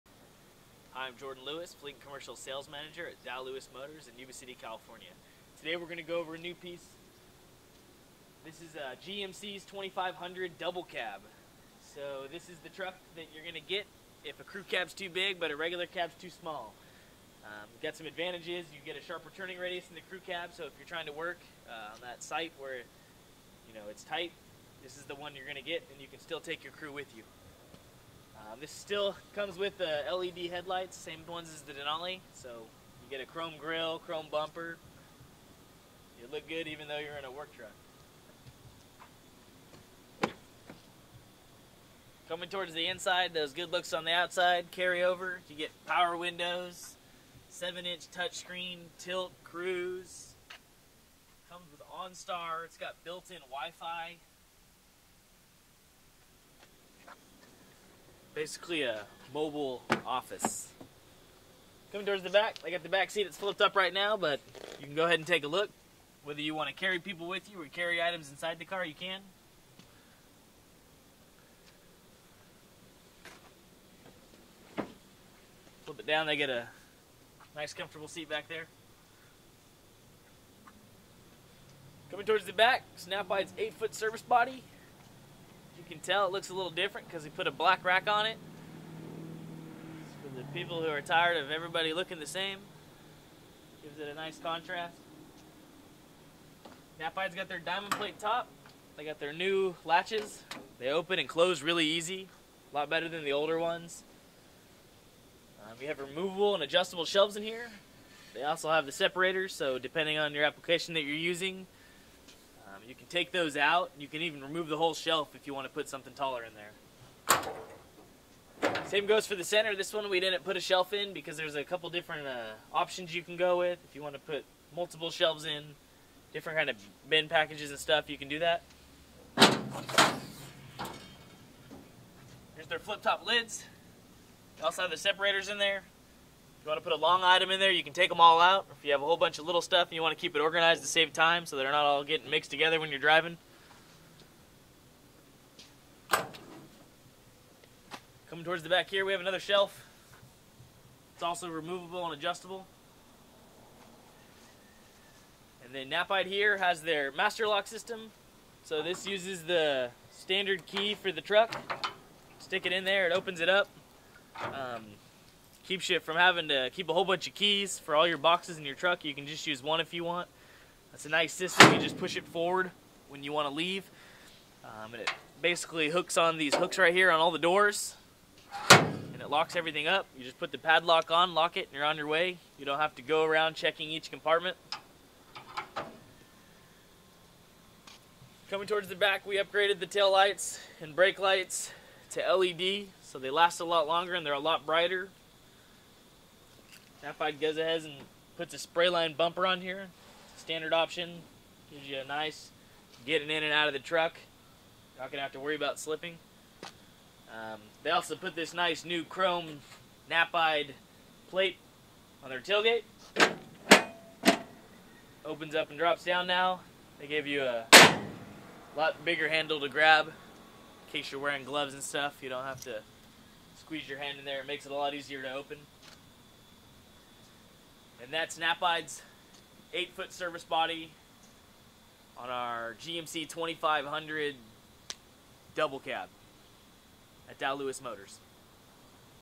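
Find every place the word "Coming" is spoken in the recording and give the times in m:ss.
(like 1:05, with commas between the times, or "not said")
0:42, 1:01, 1:22, 2:28, 3:08.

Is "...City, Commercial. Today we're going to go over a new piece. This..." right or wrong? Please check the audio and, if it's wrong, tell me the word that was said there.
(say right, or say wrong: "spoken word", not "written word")
wrong: "California", not "Commercial".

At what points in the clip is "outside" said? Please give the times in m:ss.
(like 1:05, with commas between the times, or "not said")
0:44.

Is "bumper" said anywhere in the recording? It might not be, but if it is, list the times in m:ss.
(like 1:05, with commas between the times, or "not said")
0:34, 3:19.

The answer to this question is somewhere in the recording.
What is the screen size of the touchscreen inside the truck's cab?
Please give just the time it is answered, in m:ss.
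0:47.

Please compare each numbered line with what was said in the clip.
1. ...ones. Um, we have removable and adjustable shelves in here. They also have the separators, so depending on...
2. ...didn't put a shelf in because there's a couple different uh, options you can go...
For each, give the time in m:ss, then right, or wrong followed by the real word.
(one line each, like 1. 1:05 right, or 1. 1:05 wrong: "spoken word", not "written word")
1. 1:43 right
2. 2:00 right.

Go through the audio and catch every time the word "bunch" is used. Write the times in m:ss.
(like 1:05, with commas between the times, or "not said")
2:19, 2:47.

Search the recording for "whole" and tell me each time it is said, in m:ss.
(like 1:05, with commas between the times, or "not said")
1:54, 2:19, 2:46.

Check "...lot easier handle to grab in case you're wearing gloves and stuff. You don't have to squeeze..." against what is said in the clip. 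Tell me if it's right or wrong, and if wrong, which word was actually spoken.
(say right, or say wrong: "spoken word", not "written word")
wrong: "bigger", not "easier".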